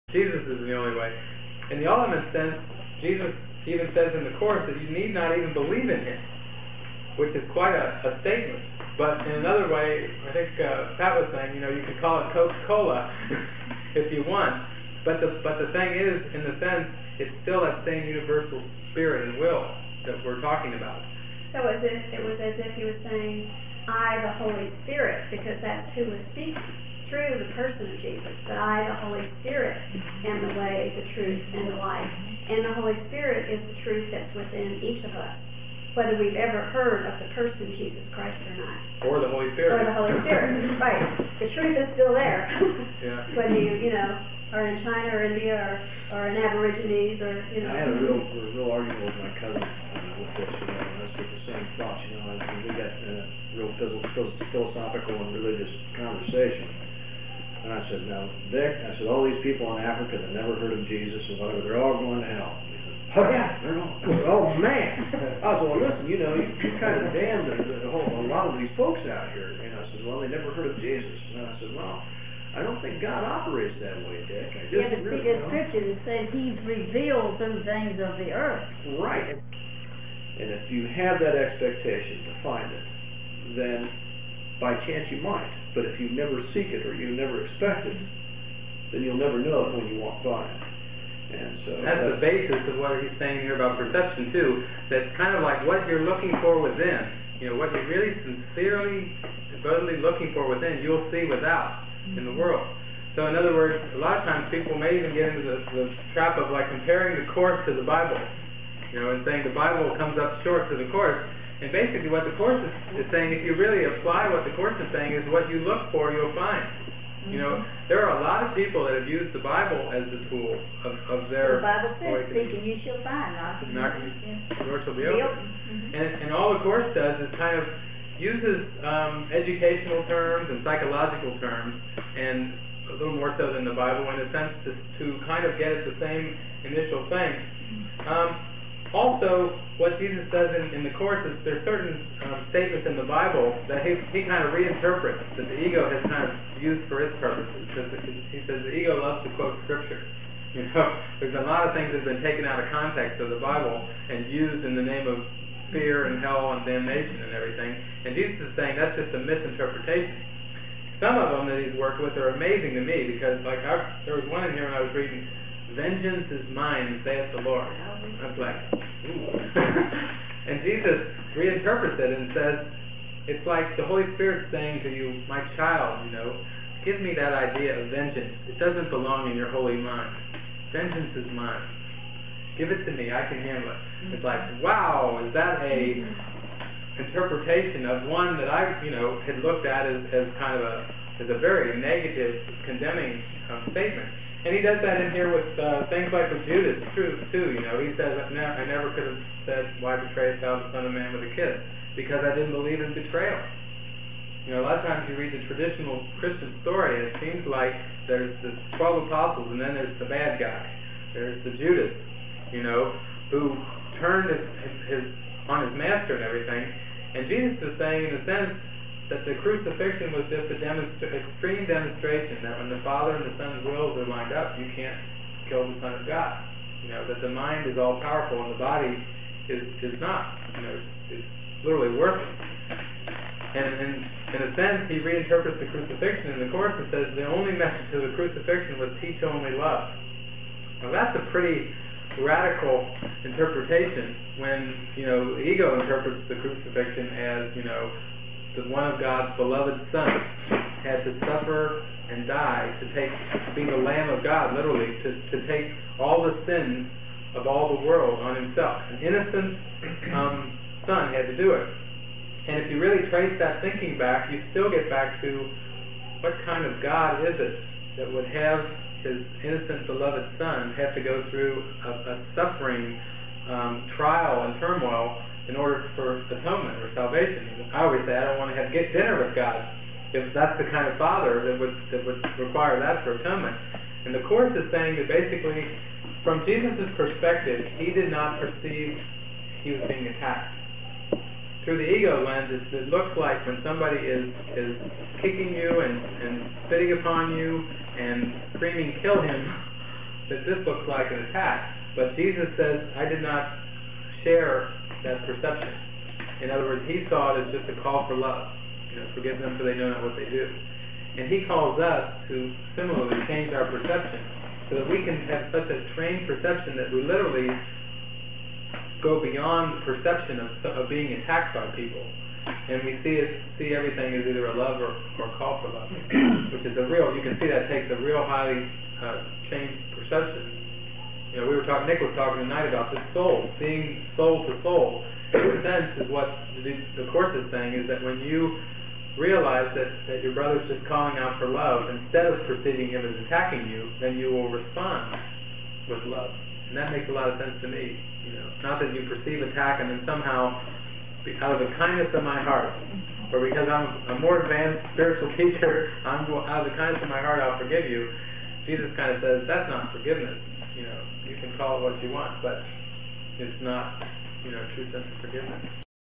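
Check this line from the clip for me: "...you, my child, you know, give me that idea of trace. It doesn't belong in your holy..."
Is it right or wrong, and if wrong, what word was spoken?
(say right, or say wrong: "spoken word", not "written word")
wrong: "vengeance", not "trace".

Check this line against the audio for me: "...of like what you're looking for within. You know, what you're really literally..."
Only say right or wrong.
wrong.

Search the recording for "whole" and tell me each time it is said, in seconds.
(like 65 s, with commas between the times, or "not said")
67 s.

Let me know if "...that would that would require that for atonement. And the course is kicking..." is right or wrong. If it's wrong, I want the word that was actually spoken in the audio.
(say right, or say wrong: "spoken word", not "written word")
wrong: "saying", not "kicking".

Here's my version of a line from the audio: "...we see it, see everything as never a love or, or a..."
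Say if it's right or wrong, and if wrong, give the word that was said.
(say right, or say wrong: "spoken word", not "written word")
wrong: "either", not "never".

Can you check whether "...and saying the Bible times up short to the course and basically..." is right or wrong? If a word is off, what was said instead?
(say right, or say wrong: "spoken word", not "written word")
wrong: "comes", not "times".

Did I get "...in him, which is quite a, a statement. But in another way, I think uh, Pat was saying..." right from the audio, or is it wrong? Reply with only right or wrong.
right.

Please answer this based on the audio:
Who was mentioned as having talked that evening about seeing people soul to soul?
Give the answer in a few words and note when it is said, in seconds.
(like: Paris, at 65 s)
Nick, at 331 s.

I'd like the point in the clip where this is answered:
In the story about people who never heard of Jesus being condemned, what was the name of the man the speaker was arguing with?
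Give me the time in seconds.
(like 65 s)
74 s.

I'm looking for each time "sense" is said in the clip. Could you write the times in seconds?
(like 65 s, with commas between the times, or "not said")
2 s, 16 s, 134 s, 218 s, 234 s, 335 s, 347 s, 364 s.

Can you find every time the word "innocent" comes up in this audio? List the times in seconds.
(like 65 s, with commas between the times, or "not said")
258 s, 269 s.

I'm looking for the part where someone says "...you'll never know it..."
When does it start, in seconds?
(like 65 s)
89 s.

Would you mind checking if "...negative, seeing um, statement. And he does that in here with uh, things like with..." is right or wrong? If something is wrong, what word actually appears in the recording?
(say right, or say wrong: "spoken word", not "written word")
wrong: "condemning", not "seeing".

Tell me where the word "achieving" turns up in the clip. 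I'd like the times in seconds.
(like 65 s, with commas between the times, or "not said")
not said.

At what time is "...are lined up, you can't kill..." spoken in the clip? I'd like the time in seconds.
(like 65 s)
223 s.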